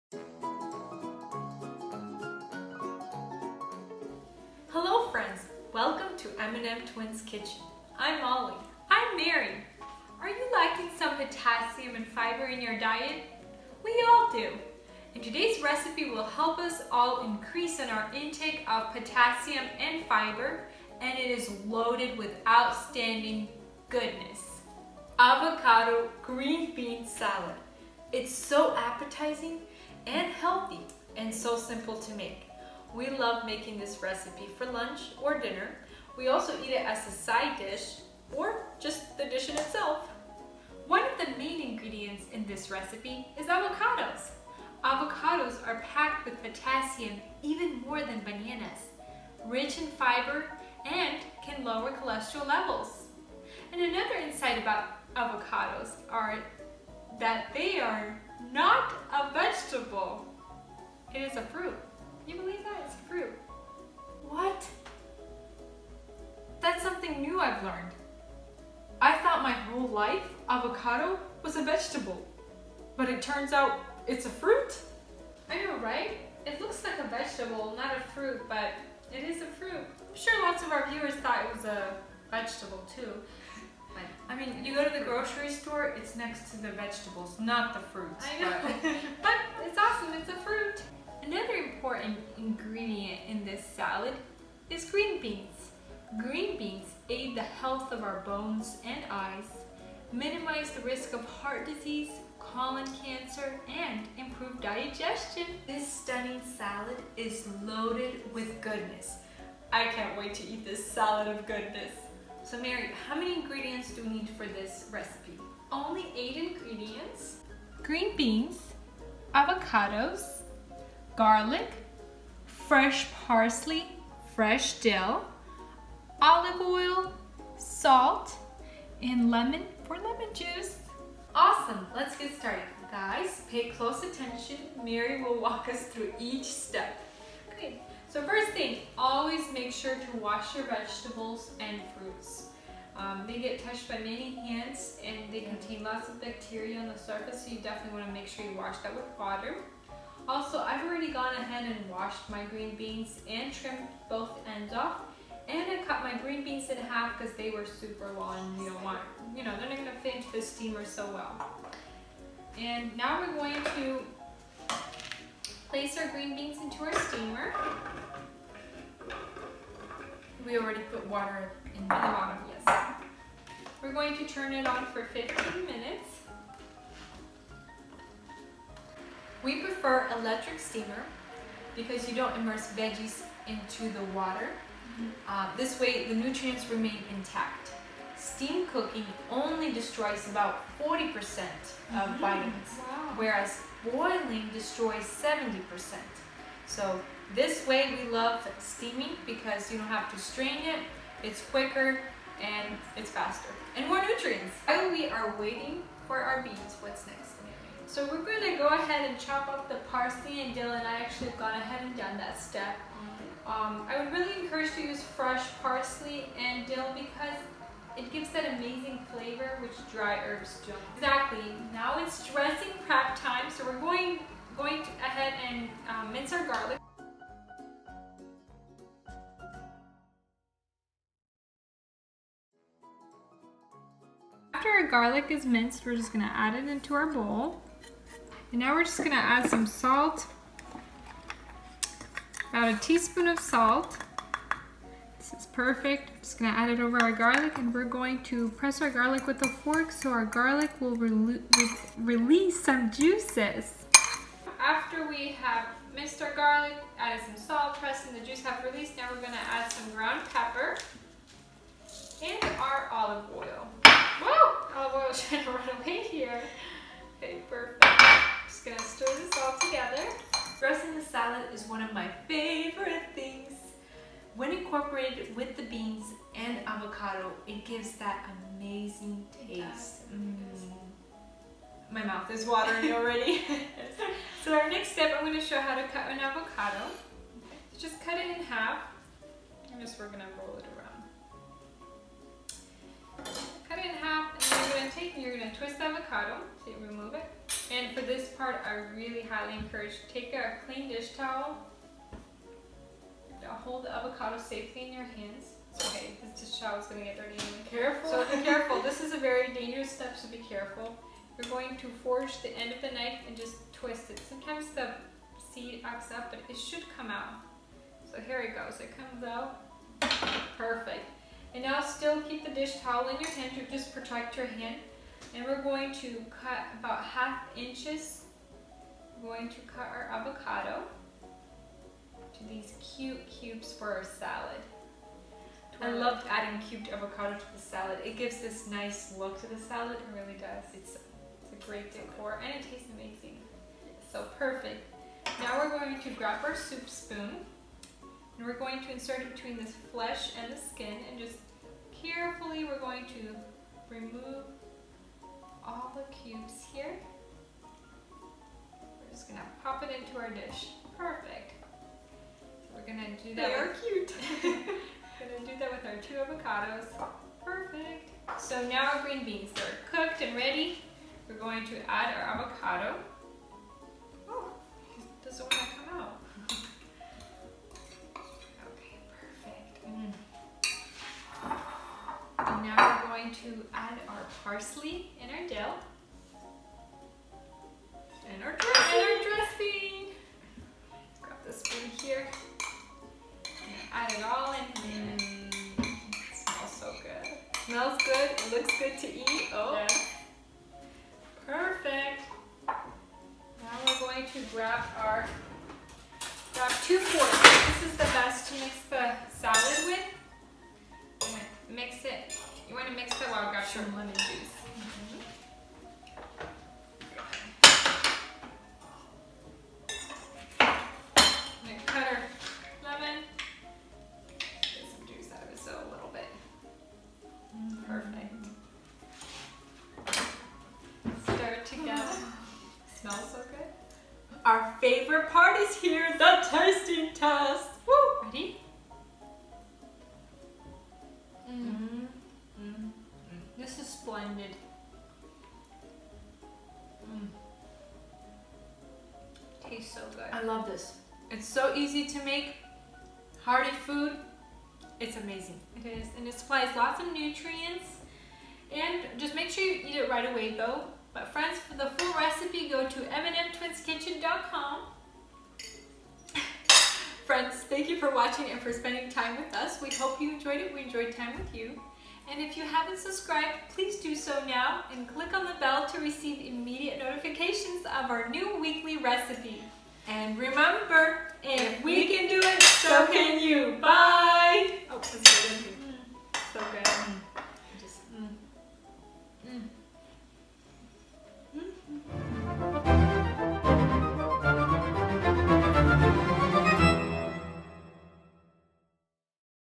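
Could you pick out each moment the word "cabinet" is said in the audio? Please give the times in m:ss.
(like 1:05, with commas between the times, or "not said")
not said.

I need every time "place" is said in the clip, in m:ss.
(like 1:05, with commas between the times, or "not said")
2:45.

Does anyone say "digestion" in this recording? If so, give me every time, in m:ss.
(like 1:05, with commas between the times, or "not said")
1:44.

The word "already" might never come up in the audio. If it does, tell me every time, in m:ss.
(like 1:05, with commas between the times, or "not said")
2:30, 2:50, 4:42.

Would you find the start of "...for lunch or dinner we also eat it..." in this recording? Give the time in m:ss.
0:34.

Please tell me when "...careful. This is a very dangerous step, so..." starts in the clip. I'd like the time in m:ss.
5:08.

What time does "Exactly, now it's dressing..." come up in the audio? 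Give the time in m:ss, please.
3:40.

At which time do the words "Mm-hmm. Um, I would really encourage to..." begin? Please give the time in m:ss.
3:32.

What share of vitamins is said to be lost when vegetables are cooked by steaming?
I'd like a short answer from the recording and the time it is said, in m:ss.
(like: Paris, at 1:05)
40%, at 3:10.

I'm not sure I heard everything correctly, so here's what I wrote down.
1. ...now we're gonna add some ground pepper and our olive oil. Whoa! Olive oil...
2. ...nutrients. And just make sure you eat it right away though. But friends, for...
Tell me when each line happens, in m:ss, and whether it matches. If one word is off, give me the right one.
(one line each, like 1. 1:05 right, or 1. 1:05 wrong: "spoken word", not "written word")
1. 4:18 right
2. 7:37 right.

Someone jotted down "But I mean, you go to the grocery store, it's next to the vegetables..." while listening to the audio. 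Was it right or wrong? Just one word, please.
right.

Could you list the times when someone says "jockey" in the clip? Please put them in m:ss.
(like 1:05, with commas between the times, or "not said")
not said.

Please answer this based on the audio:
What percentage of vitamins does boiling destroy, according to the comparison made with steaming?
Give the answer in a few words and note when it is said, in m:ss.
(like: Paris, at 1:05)
70%, at 3:15.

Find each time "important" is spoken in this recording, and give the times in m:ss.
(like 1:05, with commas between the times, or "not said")
1:31.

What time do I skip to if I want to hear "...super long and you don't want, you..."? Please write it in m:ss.
2:37.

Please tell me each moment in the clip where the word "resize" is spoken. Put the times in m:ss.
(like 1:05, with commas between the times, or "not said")
not said.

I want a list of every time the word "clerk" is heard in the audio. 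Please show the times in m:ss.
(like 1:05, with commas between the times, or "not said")
not said.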